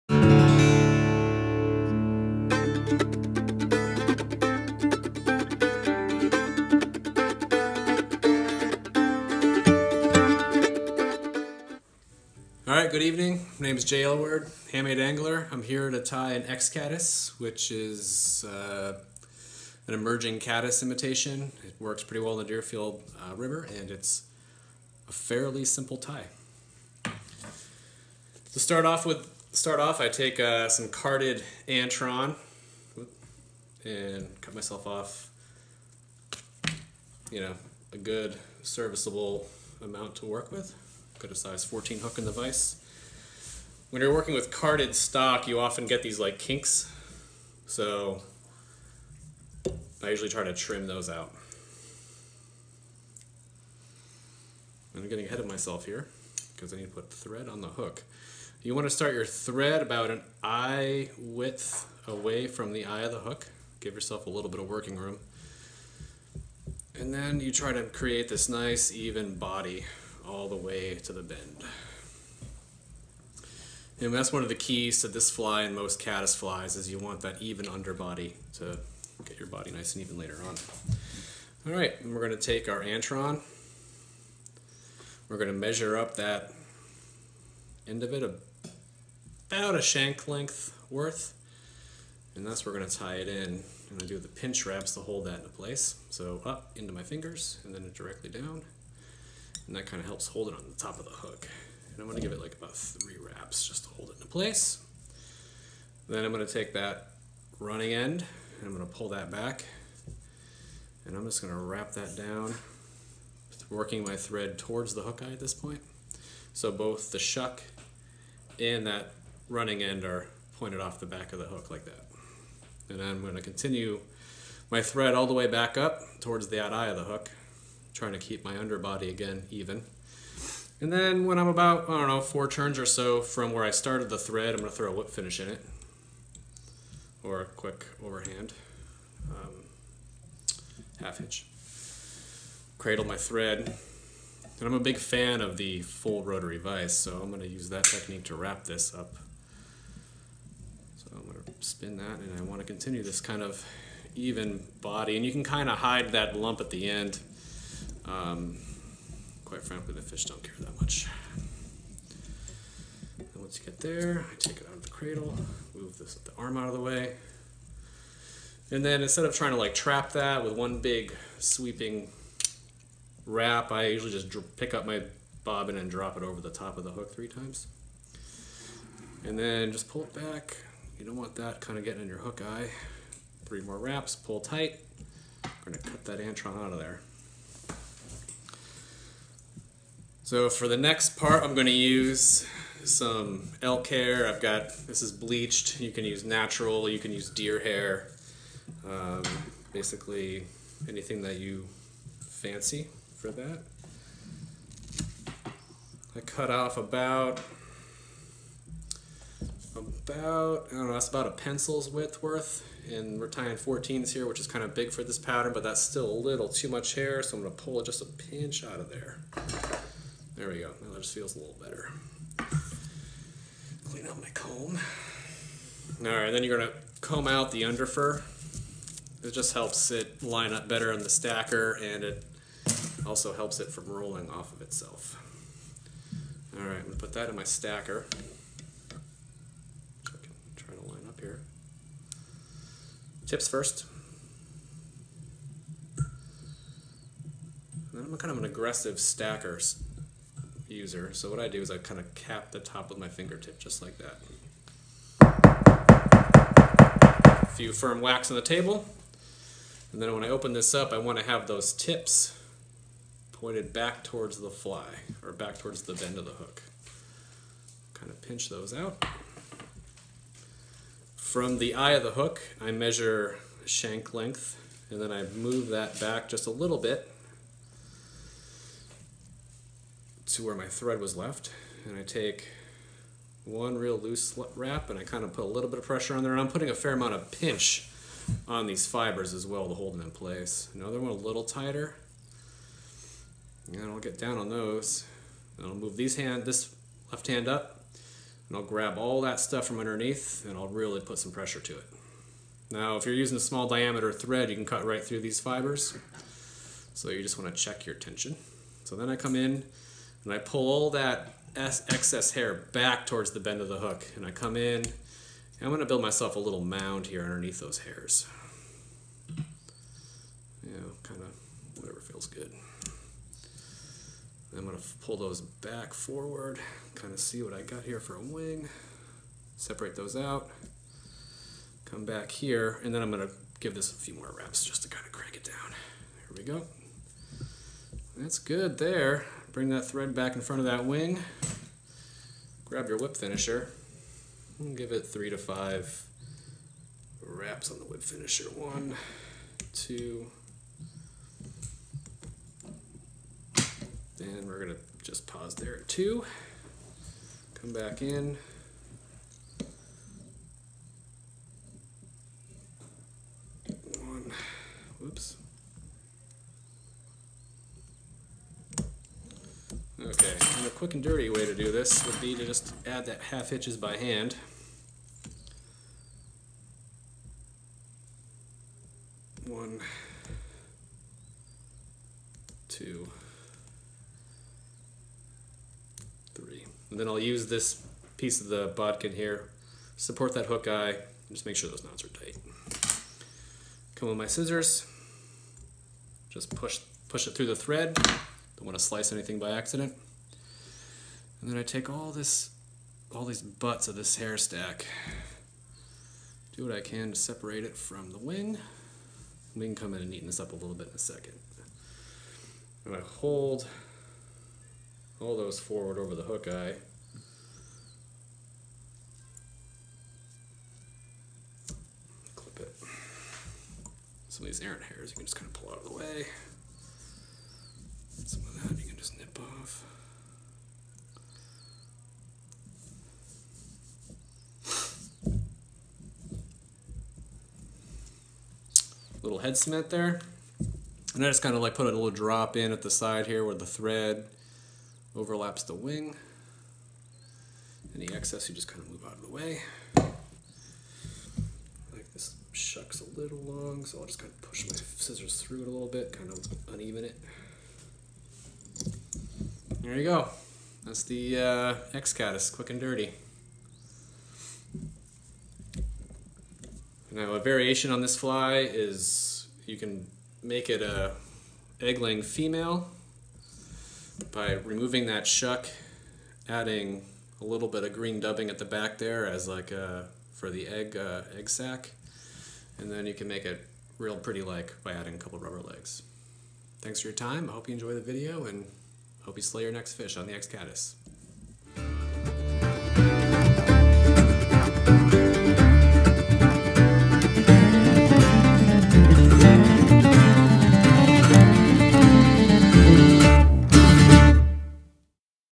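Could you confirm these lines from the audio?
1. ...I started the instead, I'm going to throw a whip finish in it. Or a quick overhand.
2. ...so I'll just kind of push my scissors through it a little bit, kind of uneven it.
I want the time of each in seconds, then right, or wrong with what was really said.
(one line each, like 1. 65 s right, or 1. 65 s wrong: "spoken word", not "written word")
1. 133 s wrong: "thread", not "instead"
2. 453 s right.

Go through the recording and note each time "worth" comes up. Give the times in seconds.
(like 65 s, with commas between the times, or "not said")
90 s, 212 s.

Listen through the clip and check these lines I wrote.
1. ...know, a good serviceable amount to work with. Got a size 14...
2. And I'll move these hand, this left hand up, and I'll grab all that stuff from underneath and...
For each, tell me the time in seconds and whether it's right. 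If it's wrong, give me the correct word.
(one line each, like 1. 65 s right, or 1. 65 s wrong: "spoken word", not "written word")
1. 37 s right
2. 295 s right.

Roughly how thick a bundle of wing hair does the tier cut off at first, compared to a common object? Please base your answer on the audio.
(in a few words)
A pencil's width.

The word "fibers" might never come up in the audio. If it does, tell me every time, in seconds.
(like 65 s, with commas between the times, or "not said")
288 s, 305 s.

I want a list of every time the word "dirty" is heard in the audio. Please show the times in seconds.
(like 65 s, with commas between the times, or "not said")
371 s, 462 s.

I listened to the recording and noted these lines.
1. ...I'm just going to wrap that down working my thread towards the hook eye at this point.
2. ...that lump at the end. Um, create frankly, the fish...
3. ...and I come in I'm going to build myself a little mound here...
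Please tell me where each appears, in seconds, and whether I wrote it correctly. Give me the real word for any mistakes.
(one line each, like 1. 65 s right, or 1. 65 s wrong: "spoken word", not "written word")
1. 111 s right
2. 156 s wrong: "quite", not "create"
3. 314 s right.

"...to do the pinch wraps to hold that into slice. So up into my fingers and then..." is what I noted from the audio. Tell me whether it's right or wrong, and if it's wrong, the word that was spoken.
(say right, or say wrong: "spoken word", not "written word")
wrong: "place", not "slice".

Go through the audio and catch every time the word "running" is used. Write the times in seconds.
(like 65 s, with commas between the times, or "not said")
107 s, 119 s.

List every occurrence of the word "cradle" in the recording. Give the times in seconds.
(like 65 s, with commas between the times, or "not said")
142 s, 164 s.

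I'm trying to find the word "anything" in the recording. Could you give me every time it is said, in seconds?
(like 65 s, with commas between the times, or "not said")
200 s, 399 s.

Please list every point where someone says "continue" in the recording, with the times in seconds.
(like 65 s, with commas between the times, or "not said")
123 s, 152 s.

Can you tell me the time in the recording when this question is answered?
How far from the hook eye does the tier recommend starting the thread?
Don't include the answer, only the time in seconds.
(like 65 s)
60 s.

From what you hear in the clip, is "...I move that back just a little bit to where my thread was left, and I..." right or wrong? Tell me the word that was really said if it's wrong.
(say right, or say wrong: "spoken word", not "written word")
right.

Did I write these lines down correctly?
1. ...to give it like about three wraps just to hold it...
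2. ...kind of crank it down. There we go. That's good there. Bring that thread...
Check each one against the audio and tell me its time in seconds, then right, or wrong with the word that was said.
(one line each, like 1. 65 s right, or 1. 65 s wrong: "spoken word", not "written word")
1. 102 s right
2. 334 s right.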